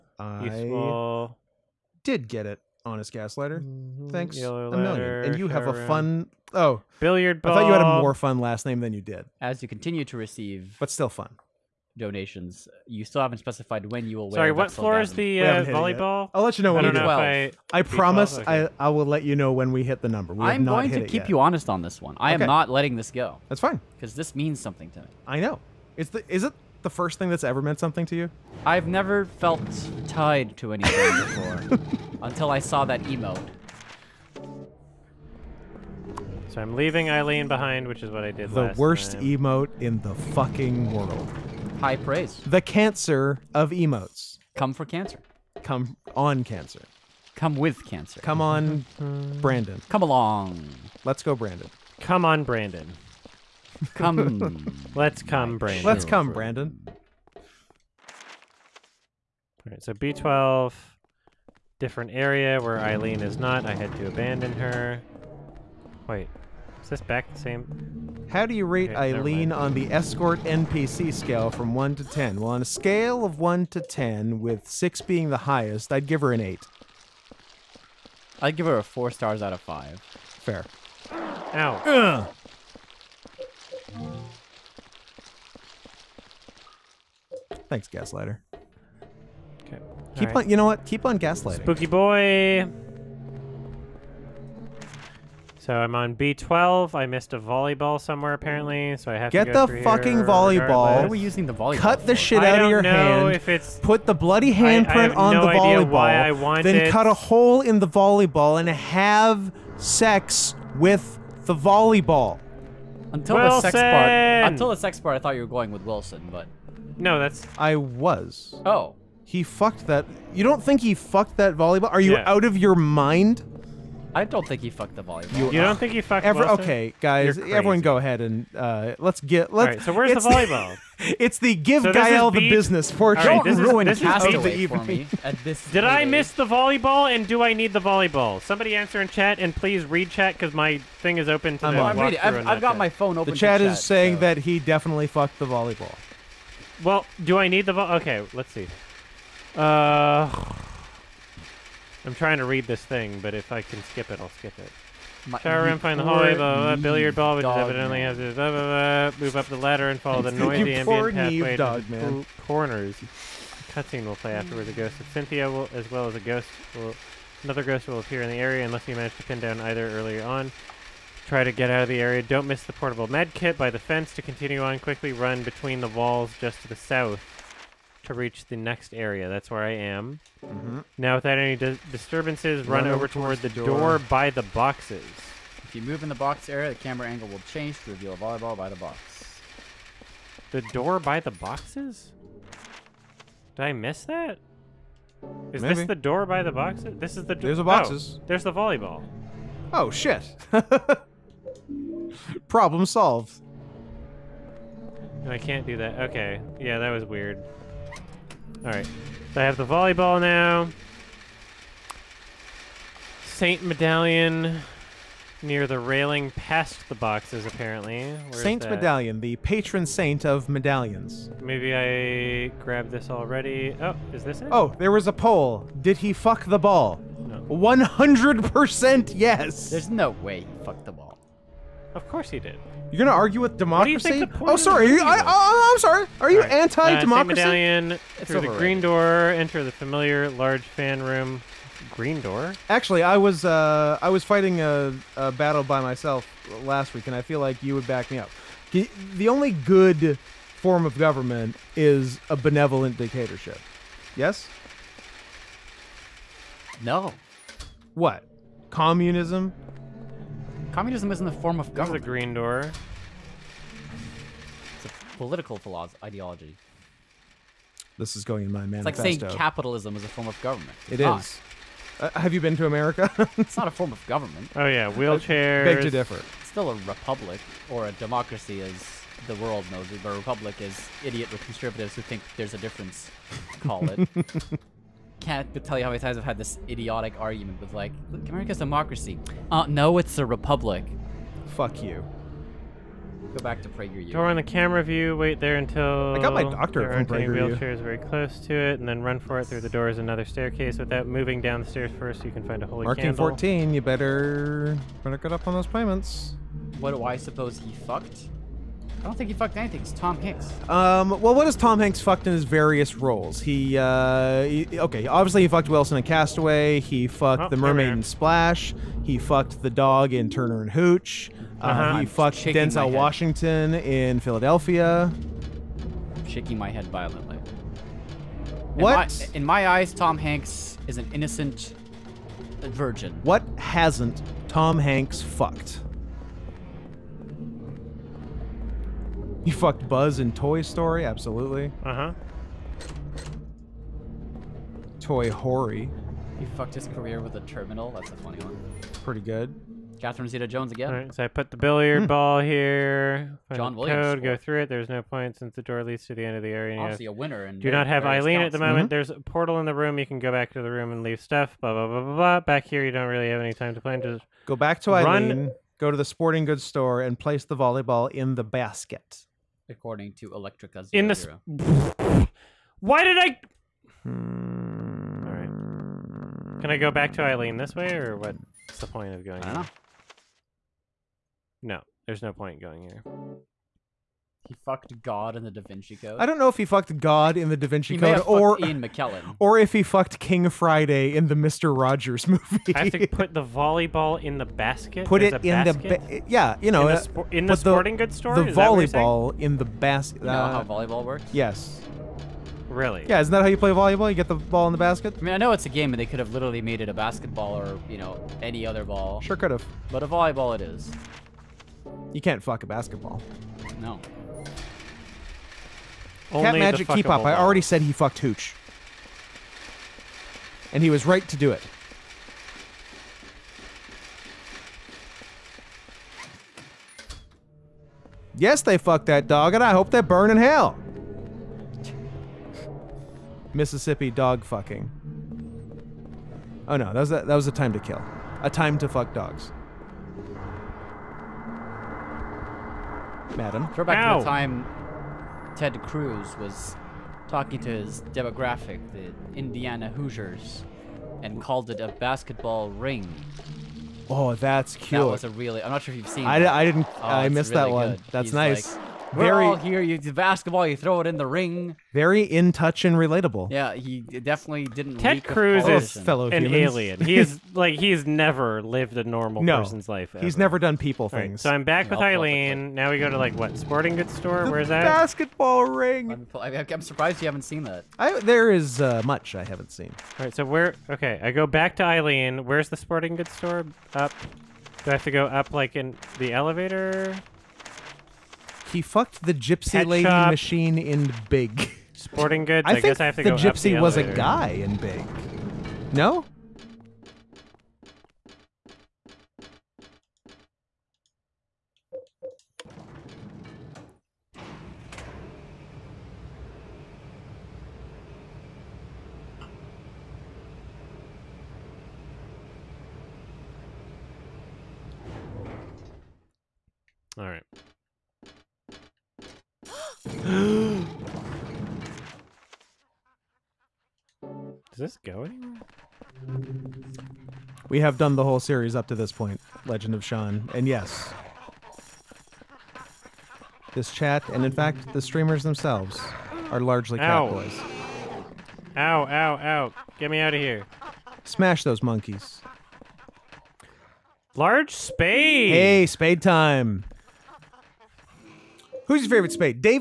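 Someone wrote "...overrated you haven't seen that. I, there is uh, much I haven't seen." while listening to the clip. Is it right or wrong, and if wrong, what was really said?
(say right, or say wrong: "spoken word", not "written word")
wrong: "surprised", not "overrated".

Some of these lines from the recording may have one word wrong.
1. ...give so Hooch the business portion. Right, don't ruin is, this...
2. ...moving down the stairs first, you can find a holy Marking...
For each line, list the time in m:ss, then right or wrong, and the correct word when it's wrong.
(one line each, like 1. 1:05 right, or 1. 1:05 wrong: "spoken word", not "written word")
1. 2:11 wrong: "Gael", not "Hooch"
2. 5:01 right.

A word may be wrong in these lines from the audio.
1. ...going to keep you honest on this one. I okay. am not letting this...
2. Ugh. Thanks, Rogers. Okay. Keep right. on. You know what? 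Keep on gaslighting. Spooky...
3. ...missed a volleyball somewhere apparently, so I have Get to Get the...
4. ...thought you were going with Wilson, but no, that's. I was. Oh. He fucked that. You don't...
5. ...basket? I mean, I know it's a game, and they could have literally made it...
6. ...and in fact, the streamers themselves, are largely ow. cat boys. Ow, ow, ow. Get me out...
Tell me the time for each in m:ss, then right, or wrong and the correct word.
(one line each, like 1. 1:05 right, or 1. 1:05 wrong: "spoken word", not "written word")
1. 0:20 right
2. 1:21 wrong: "Gaslighter", not "Rogers"
3. 1:37 right
4. 1:55 right
5. 6:44 right
6. 8:54 right.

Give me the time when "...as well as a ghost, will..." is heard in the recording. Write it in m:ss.
2:45.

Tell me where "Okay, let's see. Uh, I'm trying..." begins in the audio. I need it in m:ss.
2:28.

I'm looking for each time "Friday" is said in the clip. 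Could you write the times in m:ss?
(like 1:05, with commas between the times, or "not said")
6:30.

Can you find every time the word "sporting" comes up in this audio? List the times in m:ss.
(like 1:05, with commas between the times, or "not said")
6:06, 6:37, 7:53, 8:02, 8:11.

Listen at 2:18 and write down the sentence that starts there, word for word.
Somebody answer in chat and please read chat because my thing is open to I'm the I'm reading.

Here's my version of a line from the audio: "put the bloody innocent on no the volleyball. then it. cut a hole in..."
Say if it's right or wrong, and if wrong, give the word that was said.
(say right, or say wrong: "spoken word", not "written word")
wrong: "handprint", not "innocent".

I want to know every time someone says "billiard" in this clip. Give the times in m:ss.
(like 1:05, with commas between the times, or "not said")
0:06, 2:36, 5:51.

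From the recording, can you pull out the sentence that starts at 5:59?
You can go back to the room and leave stuff.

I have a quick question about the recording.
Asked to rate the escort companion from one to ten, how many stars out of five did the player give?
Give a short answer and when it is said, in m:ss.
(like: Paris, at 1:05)
4, at 1:18.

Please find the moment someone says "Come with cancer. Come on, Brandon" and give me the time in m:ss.
0:47.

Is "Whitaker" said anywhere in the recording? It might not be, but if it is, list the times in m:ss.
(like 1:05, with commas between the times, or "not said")
not said.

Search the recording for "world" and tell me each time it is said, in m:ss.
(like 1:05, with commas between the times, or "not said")
0:40, 4:39.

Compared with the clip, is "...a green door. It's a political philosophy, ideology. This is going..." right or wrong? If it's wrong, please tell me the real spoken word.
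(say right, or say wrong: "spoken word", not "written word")
right.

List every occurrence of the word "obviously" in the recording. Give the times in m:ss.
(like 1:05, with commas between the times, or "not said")
5:15, 5:56.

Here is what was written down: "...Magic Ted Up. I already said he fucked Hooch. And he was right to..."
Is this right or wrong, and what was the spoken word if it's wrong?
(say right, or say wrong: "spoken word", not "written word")
wrong: "Keep", not "Ted".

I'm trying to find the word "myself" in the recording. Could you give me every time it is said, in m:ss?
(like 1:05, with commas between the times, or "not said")
4:05.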